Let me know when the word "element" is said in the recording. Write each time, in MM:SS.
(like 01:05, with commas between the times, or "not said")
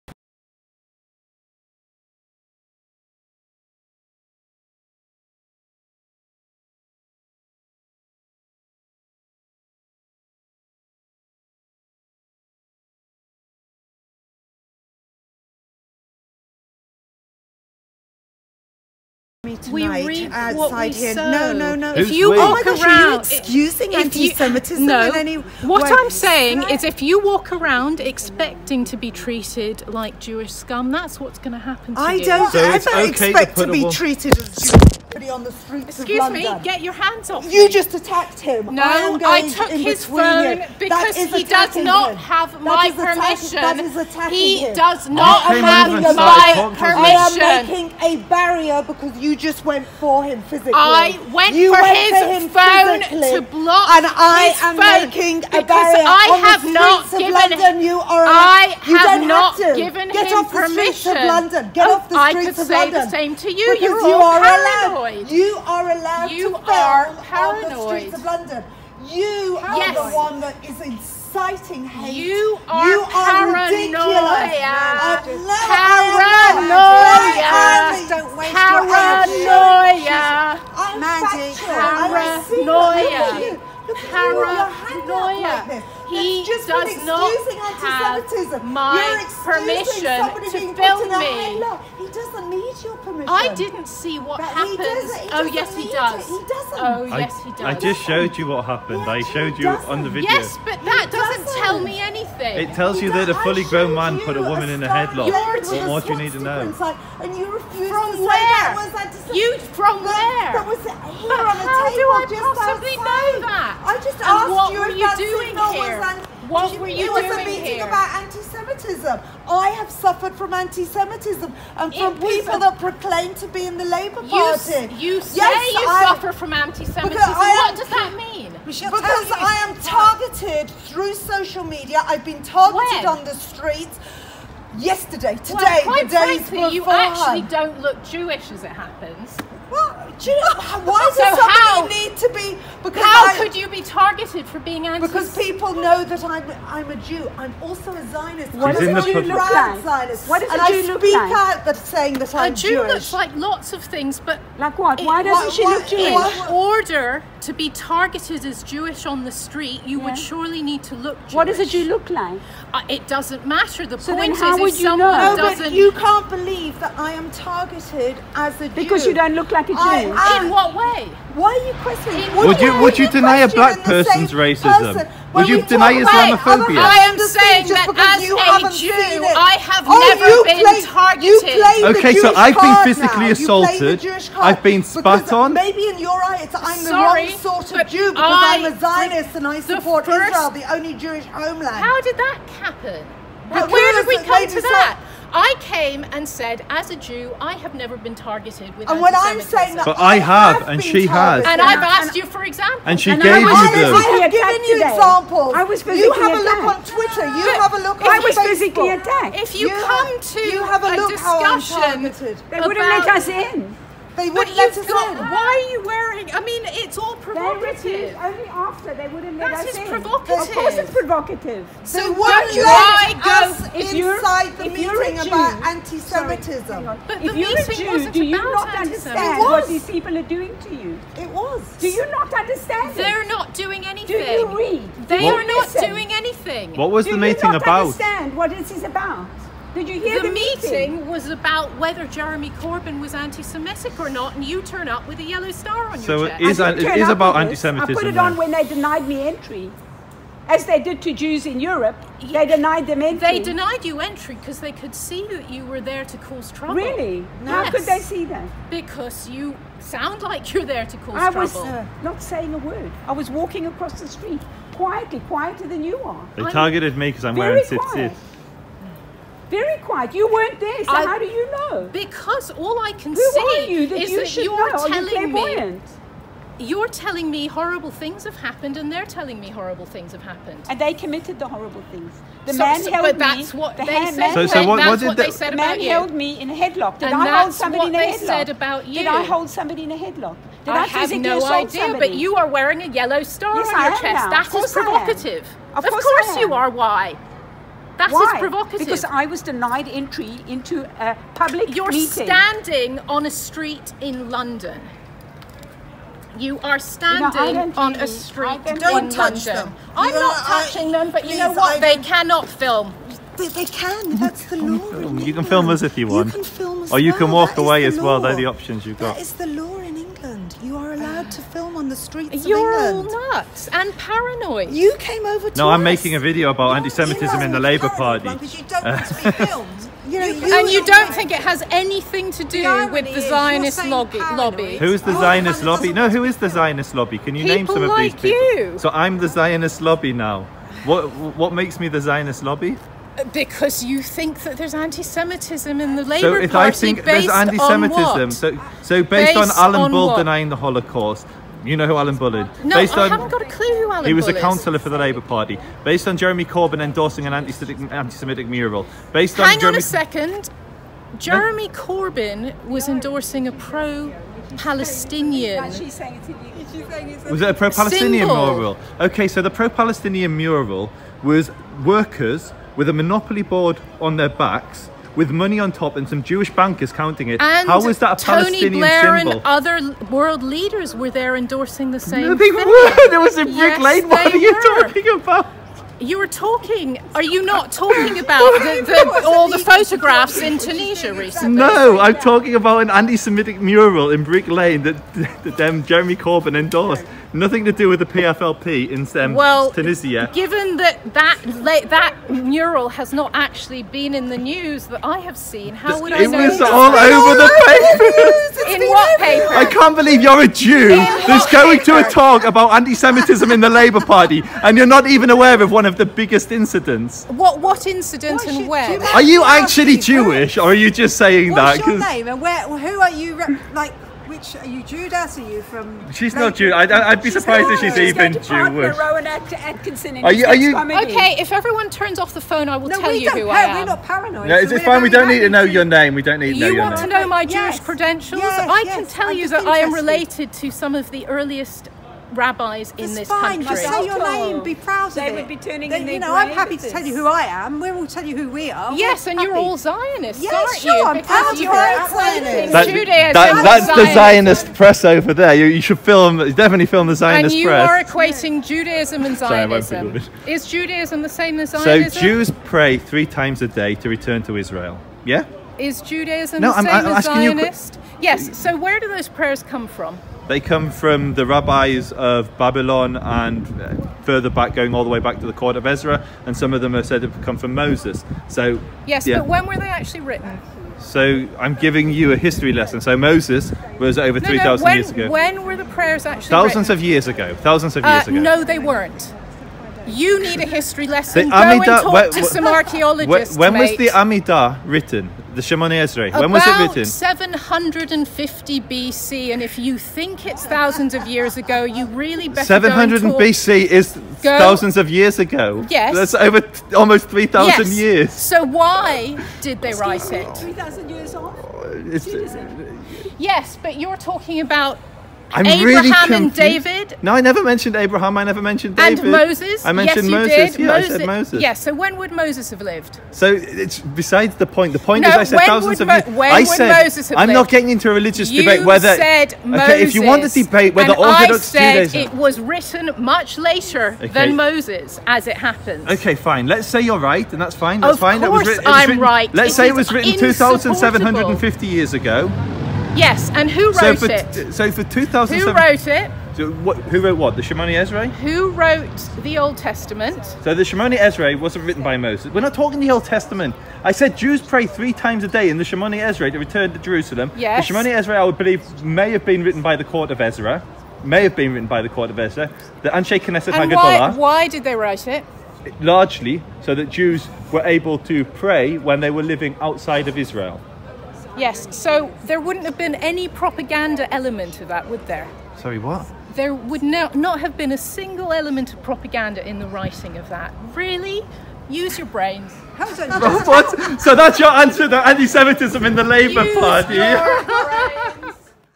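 09:34, 09:38.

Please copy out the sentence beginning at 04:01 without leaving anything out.
was about whether Jeremy Corbyn was anti-Semitic or not, and you turn up with a yellow star on so your chest.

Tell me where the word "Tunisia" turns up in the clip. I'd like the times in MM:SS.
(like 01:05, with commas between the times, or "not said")
06:30, 06:39.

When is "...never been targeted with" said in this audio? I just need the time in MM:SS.
03:17.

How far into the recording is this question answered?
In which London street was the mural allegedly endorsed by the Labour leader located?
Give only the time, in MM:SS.
06:34.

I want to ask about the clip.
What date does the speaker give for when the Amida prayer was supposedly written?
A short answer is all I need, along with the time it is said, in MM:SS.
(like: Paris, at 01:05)
750 BC, at 08:17.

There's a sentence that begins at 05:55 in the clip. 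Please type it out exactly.
Based on Jeremy Corbyn endorsing an anti-Semitic mural.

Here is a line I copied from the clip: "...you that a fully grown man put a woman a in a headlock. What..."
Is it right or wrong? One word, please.
right.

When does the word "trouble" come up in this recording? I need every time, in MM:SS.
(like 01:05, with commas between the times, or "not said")
04:16, 04:21.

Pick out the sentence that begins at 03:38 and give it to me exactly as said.
Only after they wouldn't let that us in.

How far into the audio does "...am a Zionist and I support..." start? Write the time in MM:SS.
03:08.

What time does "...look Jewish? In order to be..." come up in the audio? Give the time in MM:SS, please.
02:35.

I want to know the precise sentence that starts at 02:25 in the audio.
Because people know that I'm I'm a Jew.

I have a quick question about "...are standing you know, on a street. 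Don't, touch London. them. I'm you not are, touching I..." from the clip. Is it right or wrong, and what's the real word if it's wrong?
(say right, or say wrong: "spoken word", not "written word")
right.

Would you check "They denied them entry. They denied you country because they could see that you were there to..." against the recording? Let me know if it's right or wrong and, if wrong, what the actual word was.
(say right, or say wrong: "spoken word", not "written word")
wrong: "entry", not "country".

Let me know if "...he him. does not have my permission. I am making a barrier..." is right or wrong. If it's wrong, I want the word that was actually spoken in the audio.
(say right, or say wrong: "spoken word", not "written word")
right.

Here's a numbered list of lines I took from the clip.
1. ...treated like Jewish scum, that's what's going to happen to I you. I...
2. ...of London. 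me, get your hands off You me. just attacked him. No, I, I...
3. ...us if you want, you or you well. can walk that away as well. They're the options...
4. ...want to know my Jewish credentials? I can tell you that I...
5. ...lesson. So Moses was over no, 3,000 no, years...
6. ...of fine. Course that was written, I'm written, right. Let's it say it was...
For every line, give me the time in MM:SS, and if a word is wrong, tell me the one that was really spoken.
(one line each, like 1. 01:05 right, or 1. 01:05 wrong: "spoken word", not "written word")
1. 00:29 right
2. 00:36 right
3. 05:15 right
4. 07:16 right
5. 08:02 right
6. 08:58 right.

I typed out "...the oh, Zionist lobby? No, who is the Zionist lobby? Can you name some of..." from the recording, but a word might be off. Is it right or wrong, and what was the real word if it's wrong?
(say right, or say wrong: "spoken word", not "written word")
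right.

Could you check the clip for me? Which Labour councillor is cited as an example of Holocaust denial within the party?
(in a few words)
Alan Bull.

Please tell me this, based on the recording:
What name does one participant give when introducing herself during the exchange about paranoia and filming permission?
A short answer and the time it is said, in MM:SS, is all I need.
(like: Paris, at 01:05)
Mandy, at 01:21.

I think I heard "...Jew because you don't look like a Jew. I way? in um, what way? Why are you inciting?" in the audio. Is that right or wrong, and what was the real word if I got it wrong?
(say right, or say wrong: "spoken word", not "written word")
wrong: "questioning", not "inciting".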